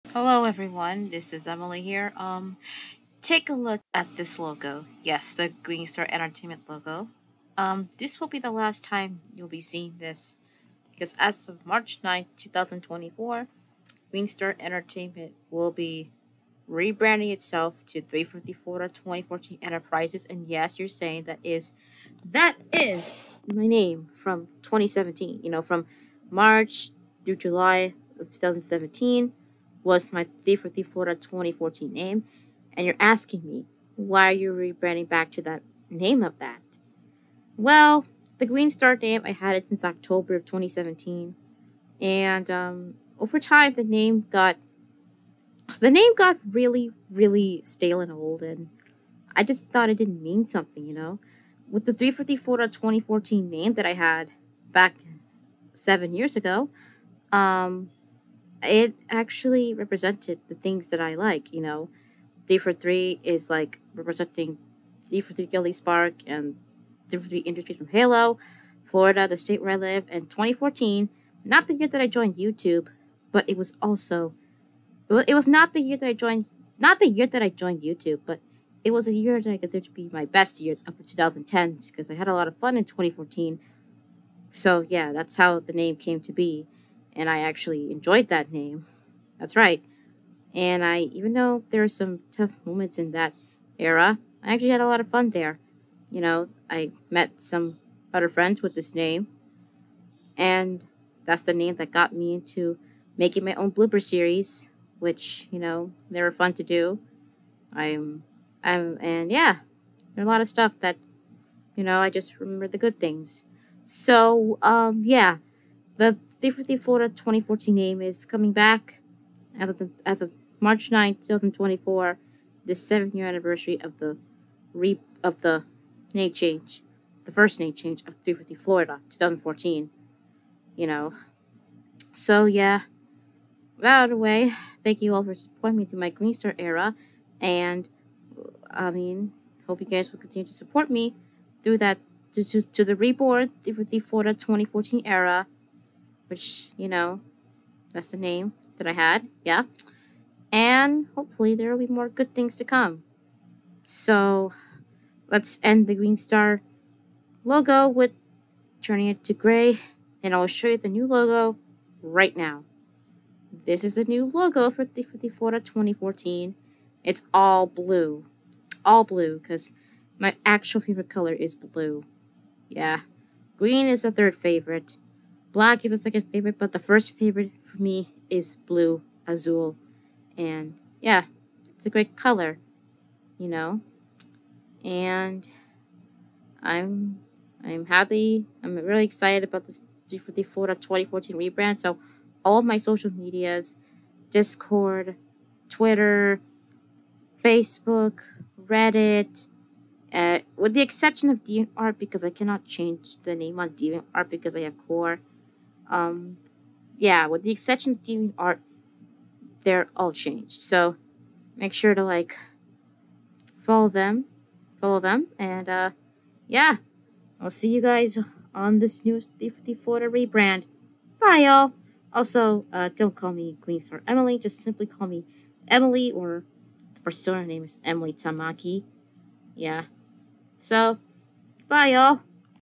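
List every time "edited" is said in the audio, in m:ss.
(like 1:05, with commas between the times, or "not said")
not said.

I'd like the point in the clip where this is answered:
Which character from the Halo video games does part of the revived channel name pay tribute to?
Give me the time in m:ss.
1:05.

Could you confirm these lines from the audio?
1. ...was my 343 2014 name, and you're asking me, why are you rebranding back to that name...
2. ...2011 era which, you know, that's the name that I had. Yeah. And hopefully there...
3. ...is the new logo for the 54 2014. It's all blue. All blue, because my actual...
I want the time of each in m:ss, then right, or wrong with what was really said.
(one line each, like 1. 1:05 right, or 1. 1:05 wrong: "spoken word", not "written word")
1. 0:29 right
2. 2:24 wrong: "2014", not "2011"
3. 2:43 right.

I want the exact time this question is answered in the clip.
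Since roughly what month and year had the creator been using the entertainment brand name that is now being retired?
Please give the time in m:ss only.
0:39.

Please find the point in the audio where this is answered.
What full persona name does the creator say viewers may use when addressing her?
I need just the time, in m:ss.
3:47.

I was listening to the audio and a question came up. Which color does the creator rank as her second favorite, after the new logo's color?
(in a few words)
Black.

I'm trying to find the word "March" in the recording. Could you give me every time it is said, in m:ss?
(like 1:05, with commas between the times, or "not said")
0:11, 0:26, 2:00.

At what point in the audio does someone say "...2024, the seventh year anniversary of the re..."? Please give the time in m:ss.
2:01.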